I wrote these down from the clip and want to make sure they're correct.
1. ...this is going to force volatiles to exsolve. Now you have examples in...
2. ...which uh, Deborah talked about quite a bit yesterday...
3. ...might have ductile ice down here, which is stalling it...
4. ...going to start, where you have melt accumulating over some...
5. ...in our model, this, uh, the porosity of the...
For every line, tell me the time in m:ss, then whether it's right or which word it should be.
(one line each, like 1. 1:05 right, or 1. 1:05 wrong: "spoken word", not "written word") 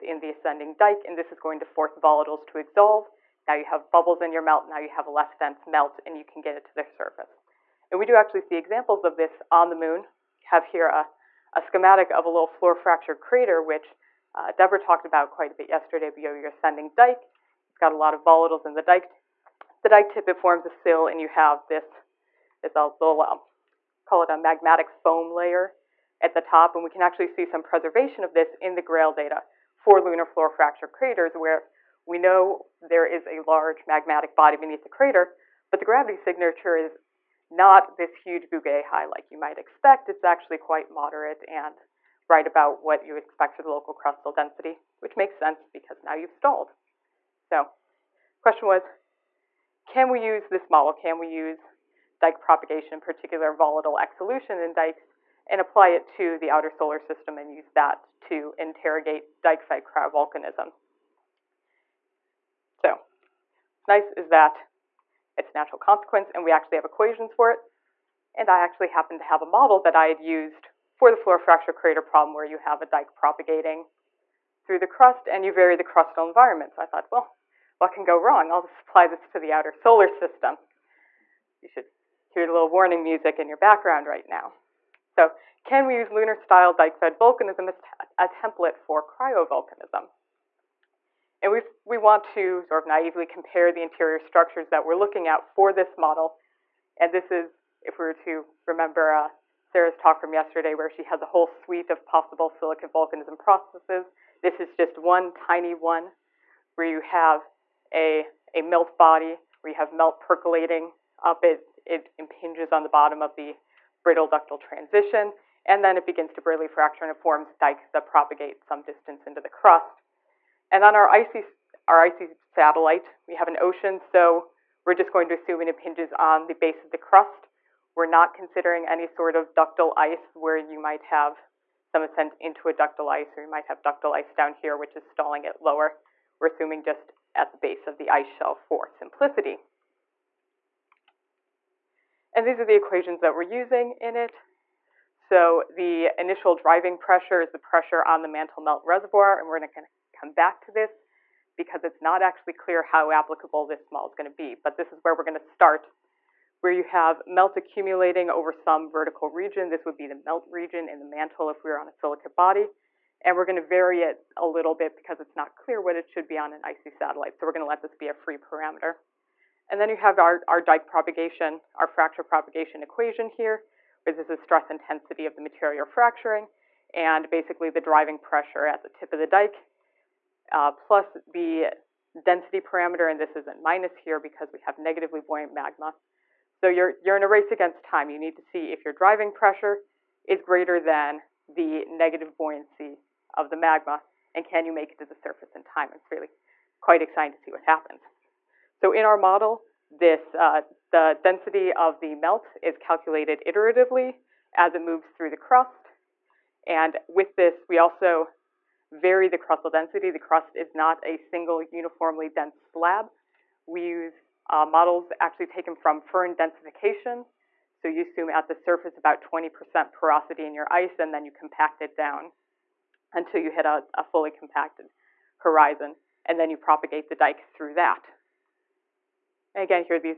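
1. 0:01 wrong: "bubbles", not "examples"
2. 0:13 right
3. 2:13 right
4. 2:35 right
5. 3:18 wrong: "density", not "porosity".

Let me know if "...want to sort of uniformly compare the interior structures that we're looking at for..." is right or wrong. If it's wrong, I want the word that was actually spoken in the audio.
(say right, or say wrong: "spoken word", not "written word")
wrong: "naively", not "uniformly".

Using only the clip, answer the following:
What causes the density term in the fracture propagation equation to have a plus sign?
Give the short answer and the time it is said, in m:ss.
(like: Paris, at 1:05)
Negatively buoyant magma, at 3:04.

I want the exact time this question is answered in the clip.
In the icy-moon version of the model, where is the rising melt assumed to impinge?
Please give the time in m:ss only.
2:06.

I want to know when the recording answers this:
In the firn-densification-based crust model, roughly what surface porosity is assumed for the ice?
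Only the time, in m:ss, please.
3:39.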